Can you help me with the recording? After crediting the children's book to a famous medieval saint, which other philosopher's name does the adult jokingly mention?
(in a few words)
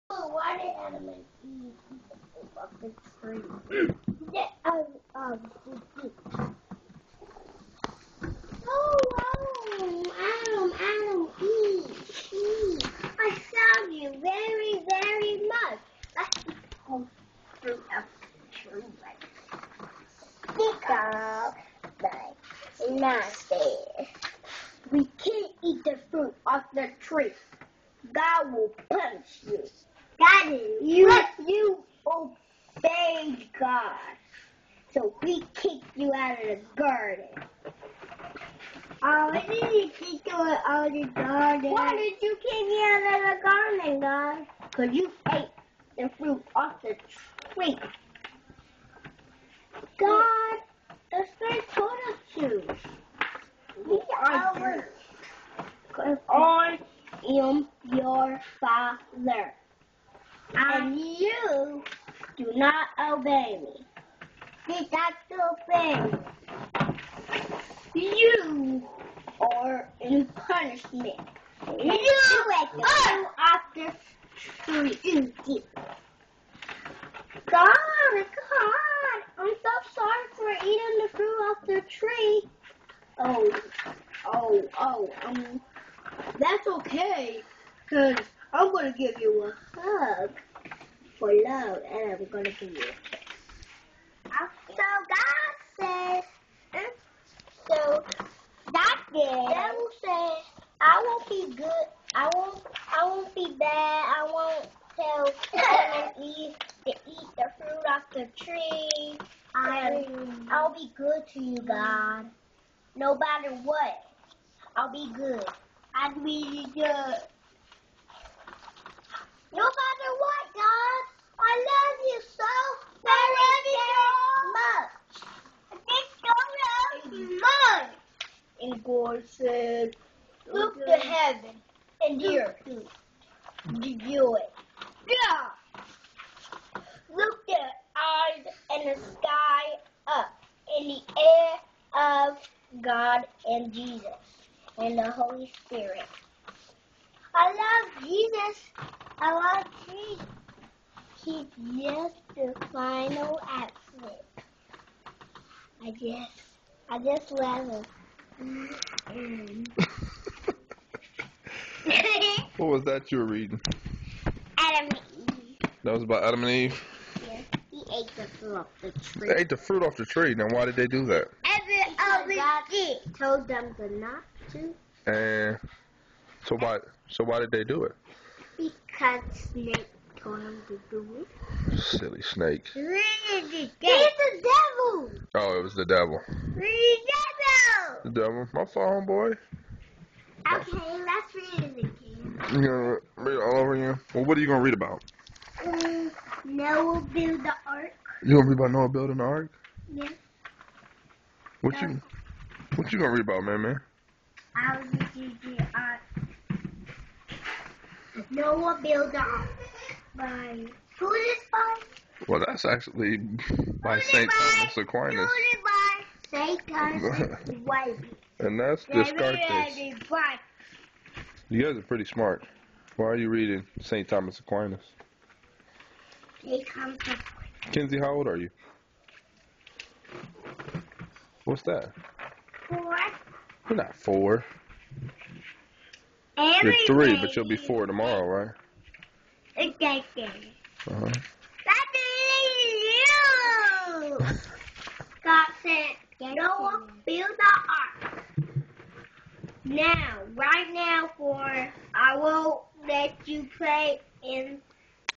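Descartes.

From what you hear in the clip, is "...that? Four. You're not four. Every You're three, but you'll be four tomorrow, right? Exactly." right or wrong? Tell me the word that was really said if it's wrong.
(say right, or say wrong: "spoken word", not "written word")
right.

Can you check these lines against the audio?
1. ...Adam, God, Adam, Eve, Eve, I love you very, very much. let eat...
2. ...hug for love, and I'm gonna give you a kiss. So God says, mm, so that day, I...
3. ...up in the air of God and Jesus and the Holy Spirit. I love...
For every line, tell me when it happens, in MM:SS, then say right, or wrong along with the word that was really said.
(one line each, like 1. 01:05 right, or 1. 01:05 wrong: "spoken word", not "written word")
1. 00:09 wrong: "Adam", not "God"
2. 01:29 right
3. 02:20 right.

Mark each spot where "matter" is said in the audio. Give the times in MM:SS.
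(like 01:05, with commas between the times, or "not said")
01:53, 01:59.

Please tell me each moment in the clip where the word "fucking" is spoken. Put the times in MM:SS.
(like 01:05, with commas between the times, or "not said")
00:02.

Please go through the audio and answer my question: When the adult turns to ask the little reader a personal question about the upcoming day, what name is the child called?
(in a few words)
Kenzie.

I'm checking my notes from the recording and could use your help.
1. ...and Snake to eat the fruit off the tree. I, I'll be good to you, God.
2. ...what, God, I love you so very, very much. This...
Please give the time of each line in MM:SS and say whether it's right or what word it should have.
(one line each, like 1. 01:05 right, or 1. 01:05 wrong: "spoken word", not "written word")
1. 01:46 wrong: "Eve", not "Snake"
2. 02:00 right.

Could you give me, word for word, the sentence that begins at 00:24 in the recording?
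We can't eat the fruit off the tree.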